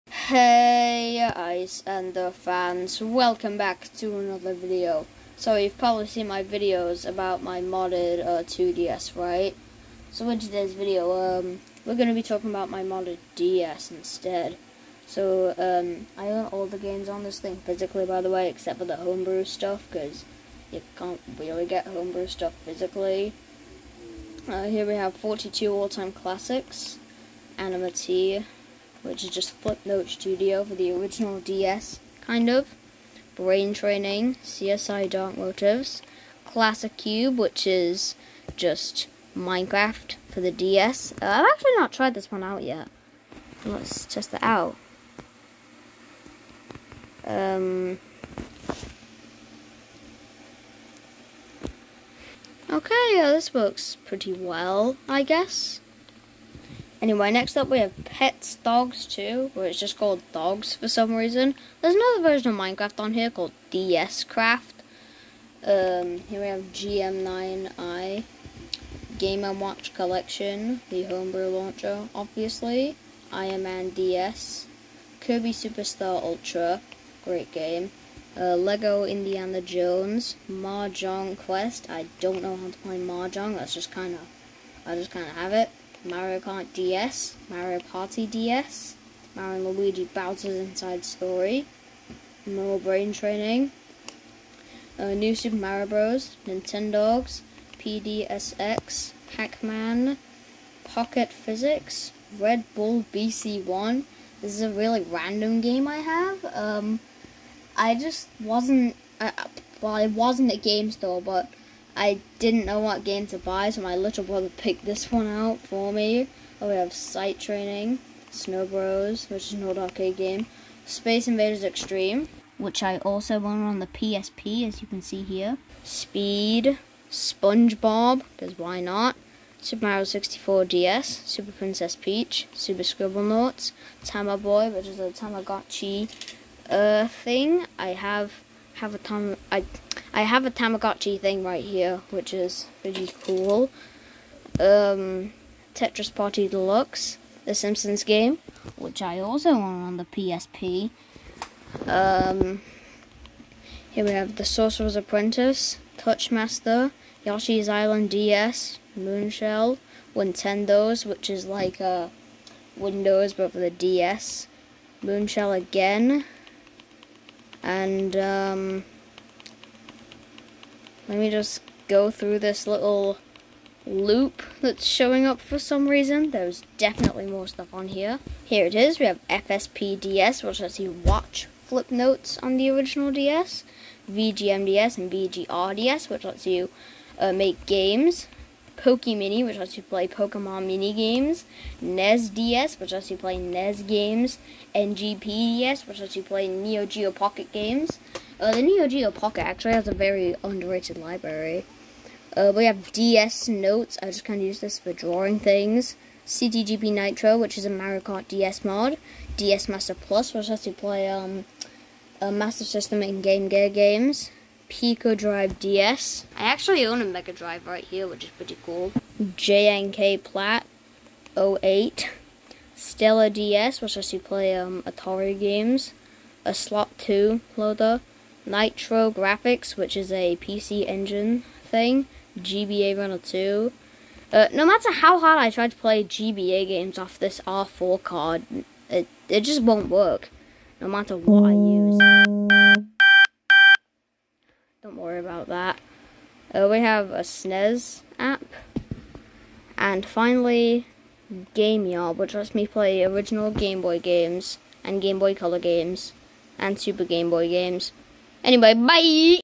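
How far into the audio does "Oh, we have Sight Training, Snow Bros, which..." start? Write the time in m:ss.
1:56.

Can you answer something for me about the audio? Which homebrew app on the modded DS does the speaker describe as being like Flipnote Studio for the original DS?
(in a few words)
Anima.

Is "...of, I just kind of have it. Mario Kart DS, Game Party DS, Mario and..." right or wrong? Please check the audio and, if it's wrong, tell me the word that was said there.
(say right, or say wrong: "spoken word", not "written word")
wrong: "Mario", not "Game".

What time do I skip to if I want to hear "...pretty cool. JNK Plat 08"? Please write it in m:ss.
3:38.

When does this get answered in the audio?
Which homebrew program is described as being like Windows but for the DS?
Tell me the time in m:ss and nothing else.
2:40.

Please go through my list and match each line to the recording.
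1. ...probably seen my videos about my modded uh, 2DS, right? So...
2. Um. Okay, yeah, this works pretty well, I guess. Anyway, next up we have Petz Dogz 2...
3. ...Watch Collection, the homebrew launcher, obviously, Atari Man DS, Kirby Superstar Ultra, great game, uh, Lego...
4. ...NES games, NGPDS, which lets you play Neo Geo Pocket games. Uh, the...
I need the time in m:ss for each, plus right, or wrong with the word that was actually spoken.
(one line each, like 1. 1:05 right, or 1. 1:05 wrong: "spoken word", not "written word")
1. 0:05 right
2. 0:47 right
3. 1:09 wrong: "Iron", not "Atari"
4. 3:13 right.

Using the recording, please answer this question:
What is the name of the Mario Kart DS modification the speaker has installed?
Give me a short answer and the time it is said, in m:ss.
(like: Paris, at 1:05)
CTGP Nitro, at 3:26.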